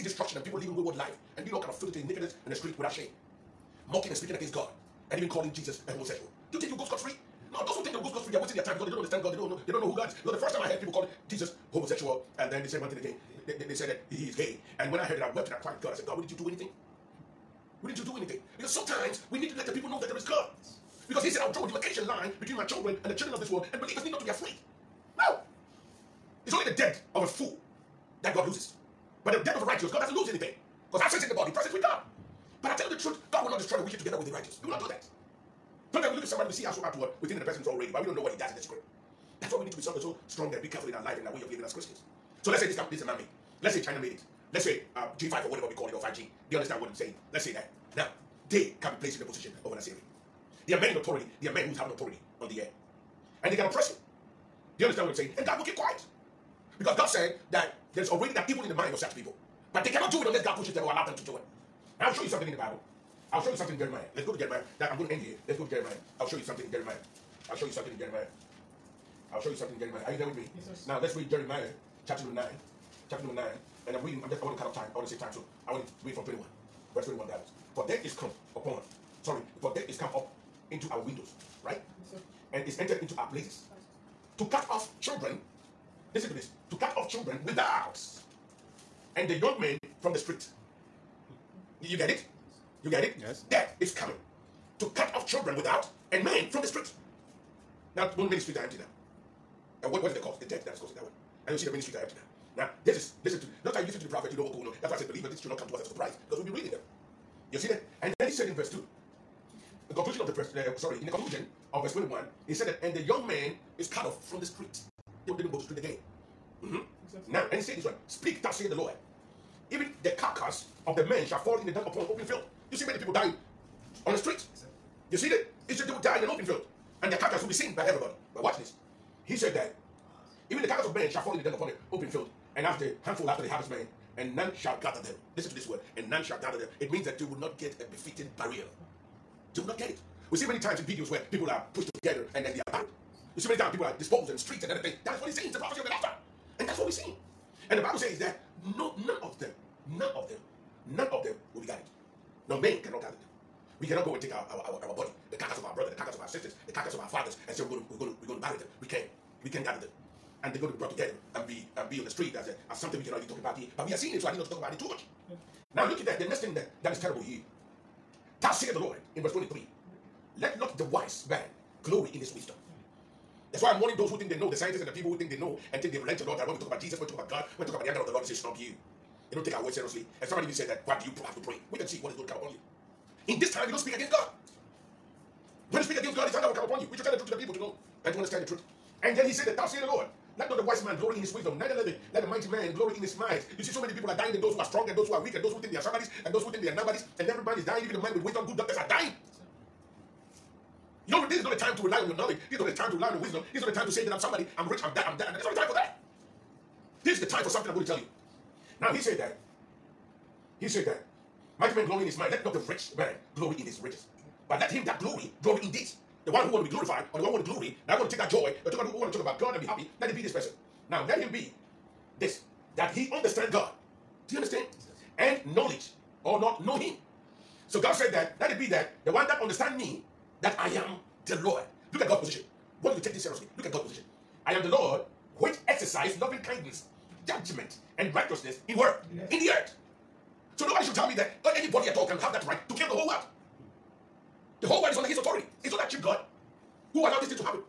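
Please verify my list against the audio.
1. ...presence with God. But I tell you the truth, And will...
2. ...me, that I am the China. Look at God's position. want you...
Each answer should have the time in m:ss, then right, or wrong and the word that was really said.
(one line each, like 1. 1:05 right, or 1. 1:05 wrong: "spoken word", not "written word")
1. 0:31 wrong: "God", not "And"
2. 3:49 wrong: "Lord", not "China".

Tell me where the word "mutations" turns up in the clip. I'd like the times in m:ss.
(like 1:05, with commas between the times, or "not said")
not said.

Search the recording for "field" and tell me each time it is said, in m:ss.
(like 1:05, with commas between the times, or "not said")
2:02, 2:06, 2:12.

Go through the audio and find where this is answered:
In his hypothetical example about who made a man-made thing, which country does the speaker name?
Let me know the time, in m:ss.
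0:43.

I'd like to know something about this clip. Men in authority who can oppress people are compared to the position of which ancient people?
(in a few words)
Assyrian.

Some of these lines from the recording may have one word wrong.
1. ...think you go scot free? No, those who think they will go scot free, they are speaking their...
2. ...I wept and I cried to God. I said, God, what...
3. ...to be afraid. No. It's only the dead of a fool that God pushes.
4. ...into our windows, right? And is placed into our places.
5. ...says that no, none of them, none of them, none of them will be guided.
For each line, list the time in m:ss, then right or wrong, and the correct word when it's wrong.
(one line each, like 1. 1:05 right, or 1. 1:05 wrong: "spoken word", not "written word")
1. 0:06 wrong: "wasting", not "speaking"
2. 0:15 right
3. 0:24 wrong: "loses", not "pushes"
4. 1:20 wrong: "entered", not "placed"
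5. 2:27 right.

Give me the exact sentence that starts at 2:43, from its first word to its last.
But we are seeing it, so I need not to talk about it too much.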